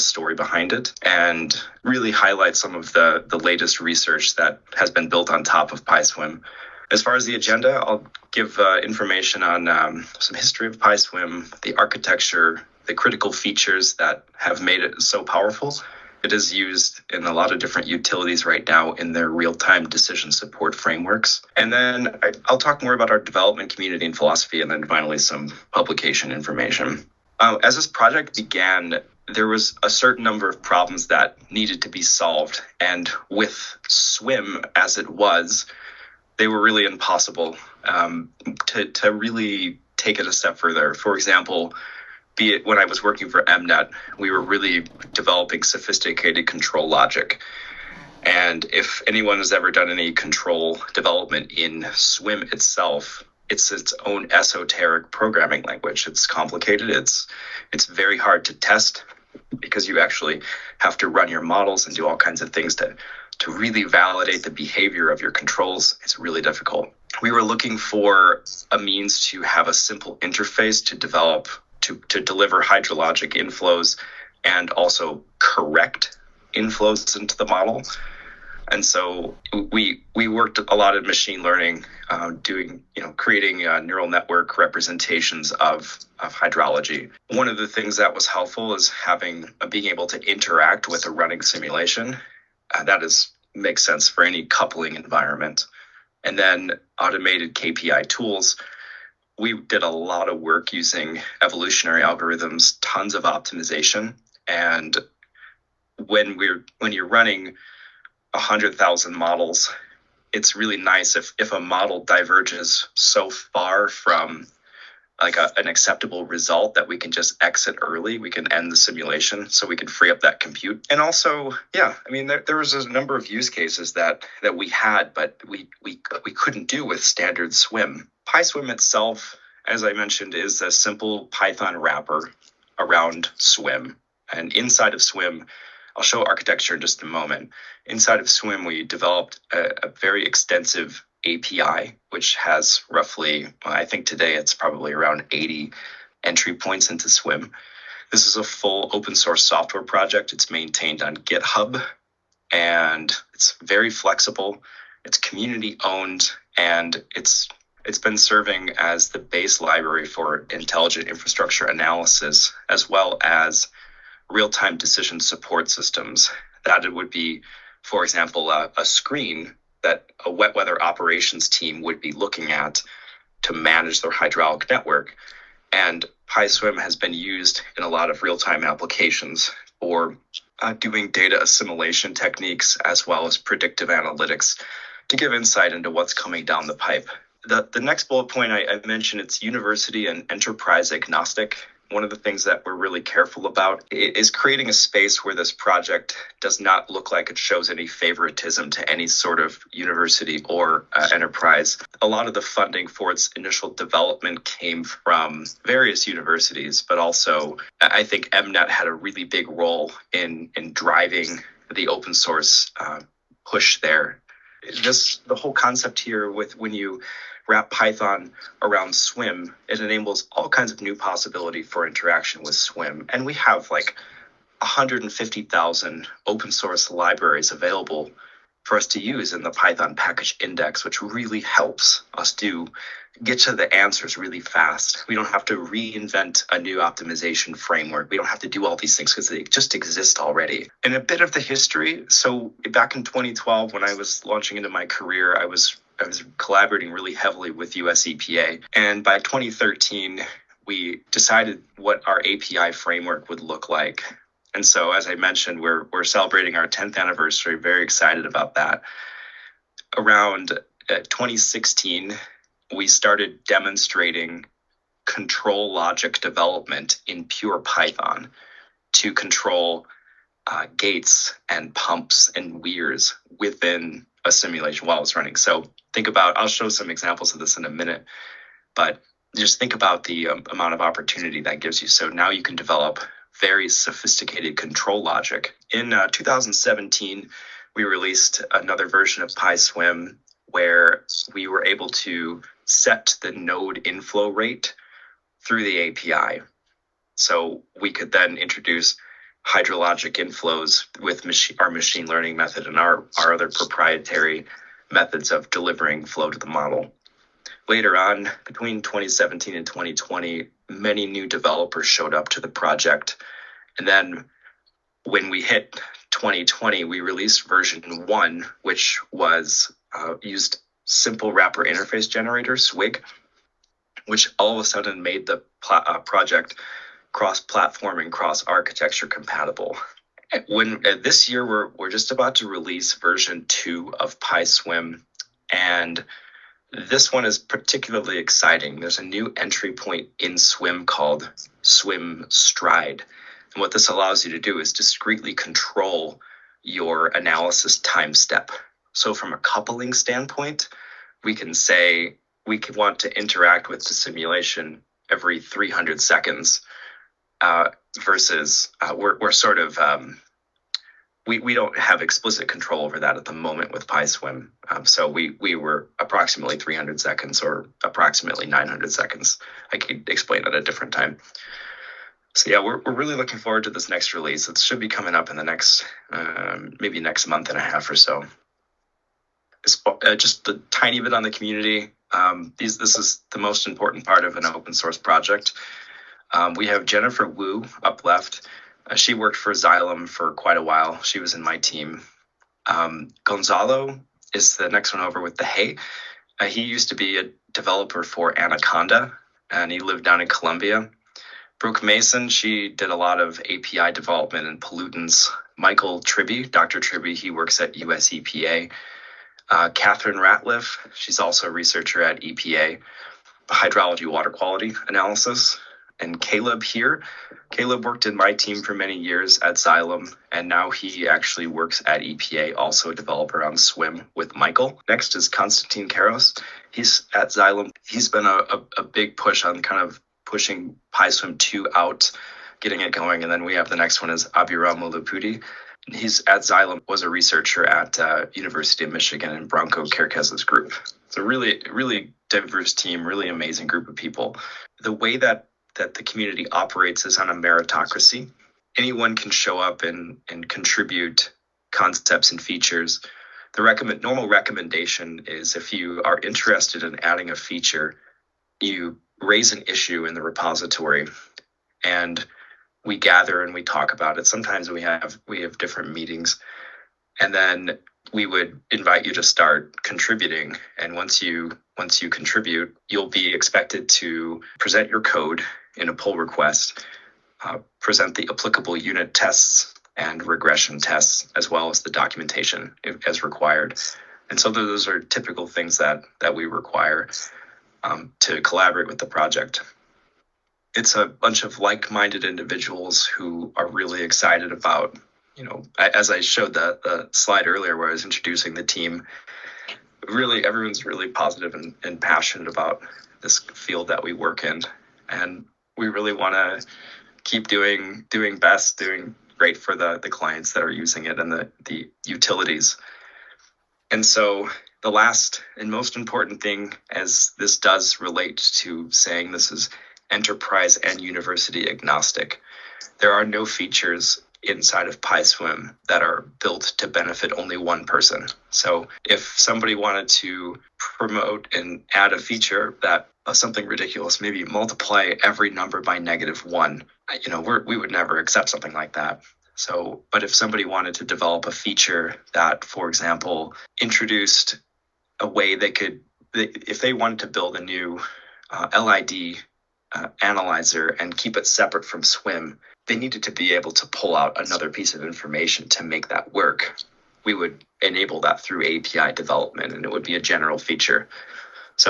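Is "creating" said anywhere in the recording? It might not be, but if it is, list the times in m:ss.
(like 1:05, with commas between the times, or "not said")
1:23, 3:14.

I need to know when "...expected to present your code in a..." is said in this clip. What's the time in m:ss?
7:53.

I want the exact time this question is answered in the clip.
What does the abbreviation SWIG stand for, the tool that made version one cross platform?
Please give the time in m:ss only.
5:20.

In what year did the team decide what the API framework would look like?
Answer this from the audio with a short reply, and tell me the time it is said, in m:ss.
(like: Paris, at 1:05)
2013, at 4:09.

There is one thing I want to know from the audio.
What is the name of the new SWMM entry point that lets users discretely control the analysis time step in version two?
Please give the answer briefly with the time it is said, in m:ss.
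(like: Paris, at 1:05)
SWMM stride, at 5:41.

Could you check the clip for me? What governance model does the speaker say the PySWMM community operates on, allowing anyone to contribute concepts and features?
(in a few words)
meritocracy.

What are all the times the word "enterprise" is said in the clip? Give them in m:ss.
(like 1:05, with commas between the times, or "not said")
3:10, 3:21, 8:40.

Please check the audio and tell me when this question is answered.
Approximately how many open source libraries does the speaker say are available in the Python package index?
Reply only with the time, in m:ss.
3:44.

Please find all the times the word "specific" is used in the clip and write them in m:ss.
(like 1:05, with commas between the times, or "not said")
not said.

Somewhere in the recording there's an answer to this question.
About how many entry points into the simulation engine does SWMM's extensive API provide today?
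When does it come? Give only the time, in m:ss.
2:25.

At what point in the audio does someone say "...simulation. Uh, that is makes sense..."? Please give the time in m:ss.
1:31.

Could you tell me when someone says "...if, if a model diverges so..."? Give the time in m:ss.
1:51.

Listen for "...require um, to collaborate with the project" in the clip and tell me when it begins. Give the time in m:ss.
8:06.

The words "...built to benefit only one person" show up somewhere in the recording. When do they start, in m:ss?
8:46.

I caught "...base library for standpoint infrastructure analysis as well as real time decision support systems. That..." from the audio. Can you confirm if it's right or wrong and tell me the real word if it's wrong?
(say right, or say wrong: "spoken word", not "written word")
wrong: "intelligent", not "standpoint".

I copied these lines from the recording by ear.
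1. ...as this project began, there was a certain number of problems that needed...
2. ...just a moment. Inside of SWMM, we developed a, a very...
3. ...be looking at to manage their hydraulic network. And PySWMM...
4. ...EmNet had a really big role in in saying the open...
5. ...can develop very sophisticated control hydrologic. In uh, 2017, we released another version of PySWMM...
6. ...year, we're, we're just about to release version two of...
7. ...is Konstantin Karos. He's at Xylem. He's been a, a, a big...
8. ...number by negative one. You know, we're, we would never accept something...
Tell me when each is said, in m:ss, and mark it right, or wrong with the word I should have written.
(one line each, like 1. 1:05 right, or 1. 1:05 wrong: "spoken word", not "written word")
1. 0:27 right
2. 2:16 right
3. 2:52 right
4. 3:28 wrong: "driving", not "saying"
5. 4:42 wrong: "logic", not "hydrologic"
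6. 5:31 right
7. 7:05 right
8. 8:55 right.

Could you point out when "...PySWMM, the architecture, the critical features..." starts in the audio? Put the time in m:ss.
0:10.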